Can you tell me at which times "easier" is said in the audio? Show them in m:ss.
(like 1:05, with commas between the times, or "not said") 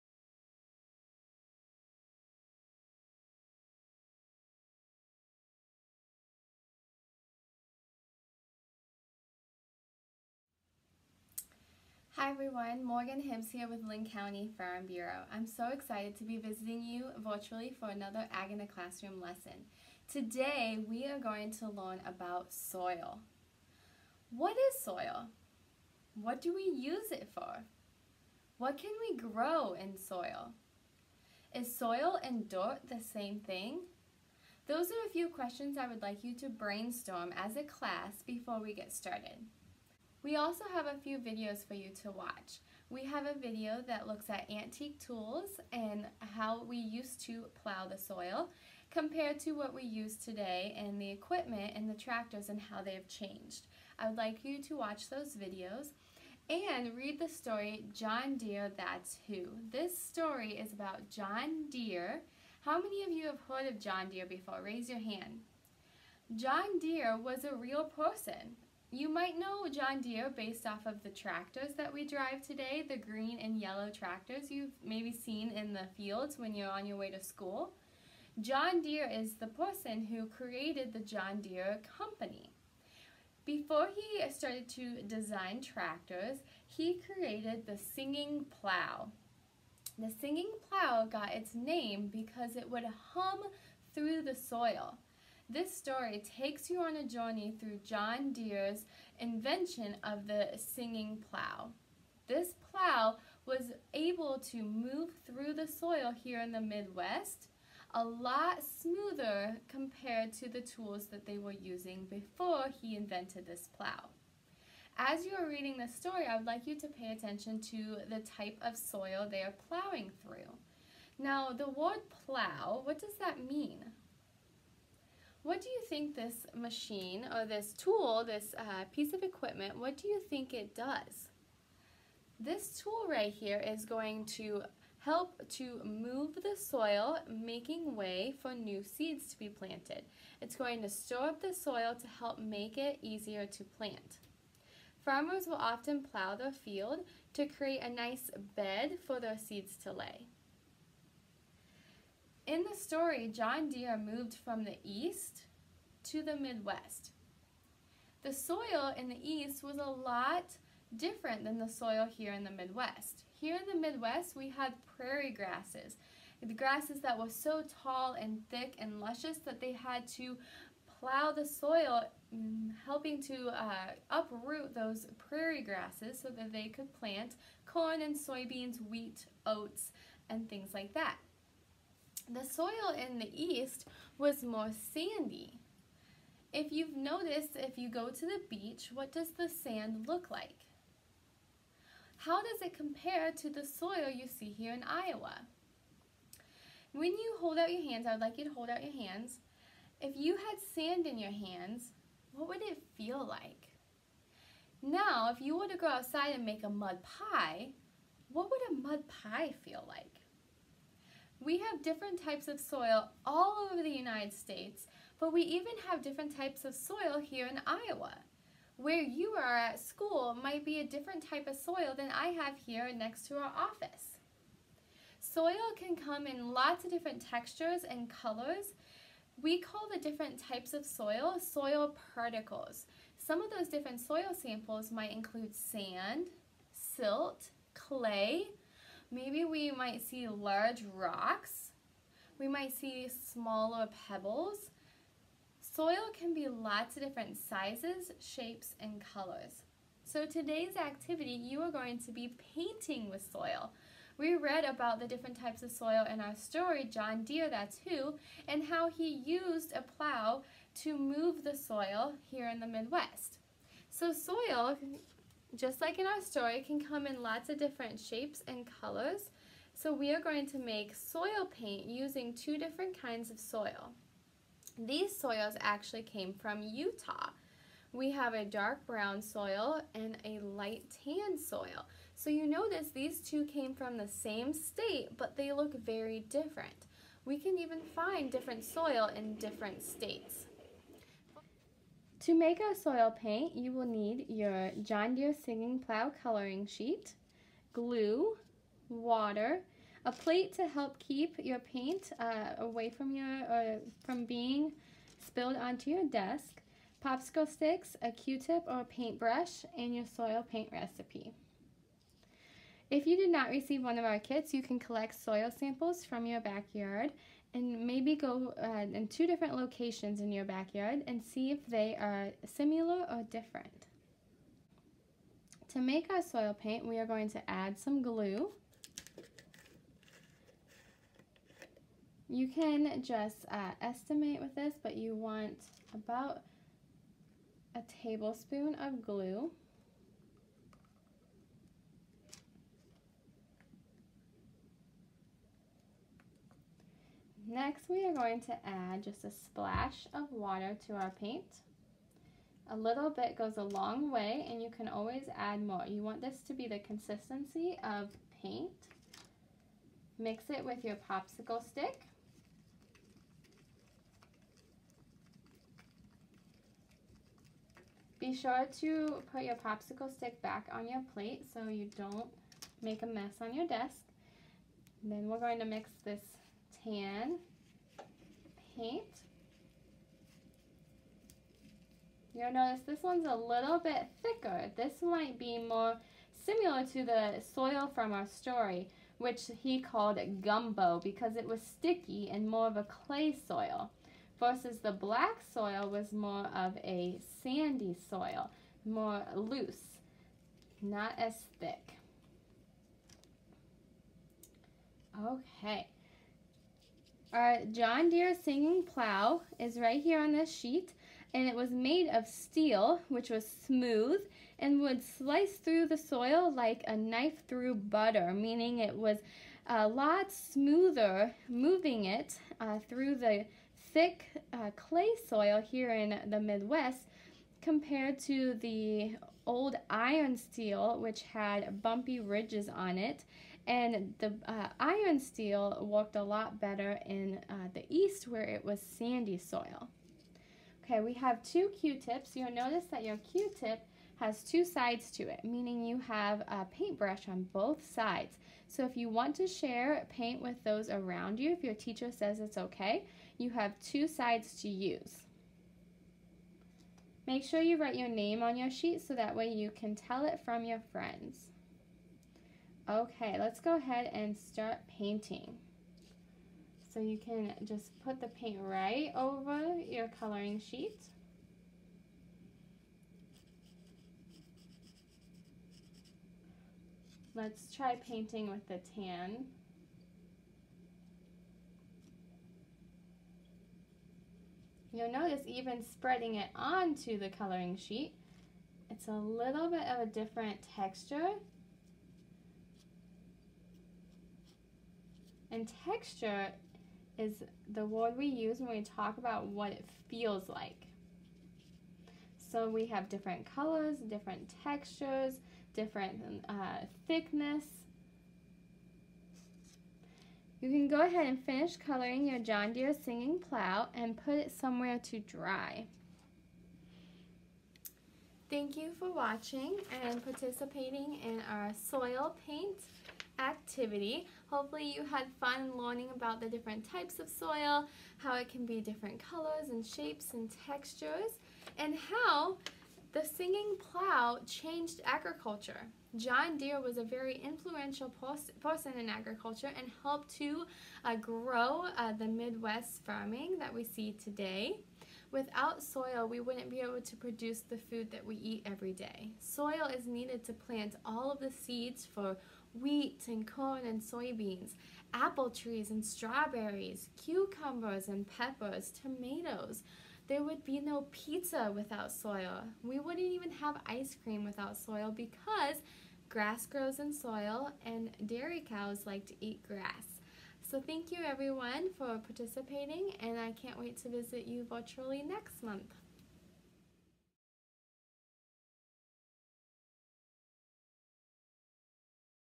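2:23.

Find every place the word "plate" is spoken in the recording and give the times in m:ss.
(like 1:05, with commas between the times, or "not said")
5:00, 6:11.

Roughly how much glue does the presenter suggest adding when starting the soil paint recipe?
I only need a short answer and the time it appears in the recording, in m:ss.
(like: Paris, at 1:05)
a tablespoon, at 5:37.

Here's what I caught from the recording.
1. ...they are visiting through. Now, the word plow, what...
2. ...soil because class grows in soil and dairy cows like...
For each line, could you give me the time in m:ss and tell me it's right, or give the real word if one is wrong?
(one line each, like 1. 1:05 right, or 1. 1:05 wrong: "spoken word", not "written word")
1. 1:59 wrong: "plowing", not "visiting"
2. 9:24 wrong: "grass", not "class".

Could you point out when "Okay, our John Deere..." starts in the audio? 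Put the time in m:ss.
6:45.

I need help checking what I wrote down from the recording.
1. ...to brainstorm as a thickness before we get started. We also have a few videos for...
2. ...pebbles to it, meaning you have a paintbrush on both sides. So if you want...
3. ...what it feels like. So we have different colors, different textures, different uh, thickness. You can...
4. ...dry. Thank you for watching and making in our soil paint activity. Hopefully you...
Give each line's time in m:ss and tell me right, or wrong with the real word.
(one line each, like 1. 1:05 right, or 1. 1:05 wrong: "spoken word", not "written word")
1. 0:36 wrong: "class", not "thickness"
2. 7:24 wrong: "sides", not "pebbles"
3. 8:19 right
4. 8:35 wrong: "participating", not "making".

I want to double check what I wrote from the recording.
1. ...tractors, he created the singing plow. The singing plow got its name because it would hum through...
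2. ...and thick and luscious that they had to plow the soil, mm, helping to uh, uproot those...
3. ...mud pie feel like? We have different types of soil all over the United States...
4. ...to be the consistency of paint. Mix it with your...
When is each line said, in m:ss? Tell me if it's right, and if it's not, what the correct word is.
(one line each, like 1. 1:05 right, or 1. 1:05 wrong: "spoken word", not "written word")
1. 1:25 right
2. 2:48 right
3. 3:28 right
4. 5:56 right.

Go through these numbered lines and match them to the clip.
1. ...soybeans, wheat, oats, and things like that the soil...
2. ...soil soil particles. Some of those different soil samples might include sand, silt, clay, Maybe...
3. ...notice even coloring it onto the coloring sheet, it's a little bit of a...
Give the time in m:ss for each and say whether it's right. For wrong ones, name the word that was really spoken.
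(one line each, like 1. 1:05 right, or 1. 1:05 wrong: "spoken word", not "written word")
1. 2:58 right
2. 3:50 right
3. 8:05 wrong: "spreading", not "coloring".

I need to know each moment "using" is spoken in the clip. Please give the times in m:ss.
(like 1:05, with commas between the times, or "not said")
1:51, 4:31.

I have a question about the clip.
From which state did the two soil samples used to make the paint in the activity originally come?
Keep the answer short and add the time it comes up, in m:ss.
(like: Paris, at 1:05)
Utah, at 4:36.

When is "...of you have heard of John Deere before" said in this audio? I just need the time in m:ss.
1:03.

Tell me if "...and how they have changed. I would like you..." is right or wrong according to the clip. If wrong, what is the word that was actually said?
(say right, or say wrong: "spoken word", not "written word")
right.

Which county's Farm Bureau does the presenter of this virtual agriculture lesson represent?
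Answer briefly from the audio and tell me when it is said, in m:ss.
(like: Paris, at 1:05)
Linn County, at 0:13.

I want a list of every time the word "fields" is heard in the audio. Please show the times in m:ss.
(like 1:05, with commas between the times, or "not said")
1:15, 2:26.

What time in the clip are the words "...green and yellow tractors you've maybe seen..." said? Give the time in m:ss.
1:12.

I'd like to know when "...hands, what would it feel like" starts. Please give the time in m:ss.
3:21.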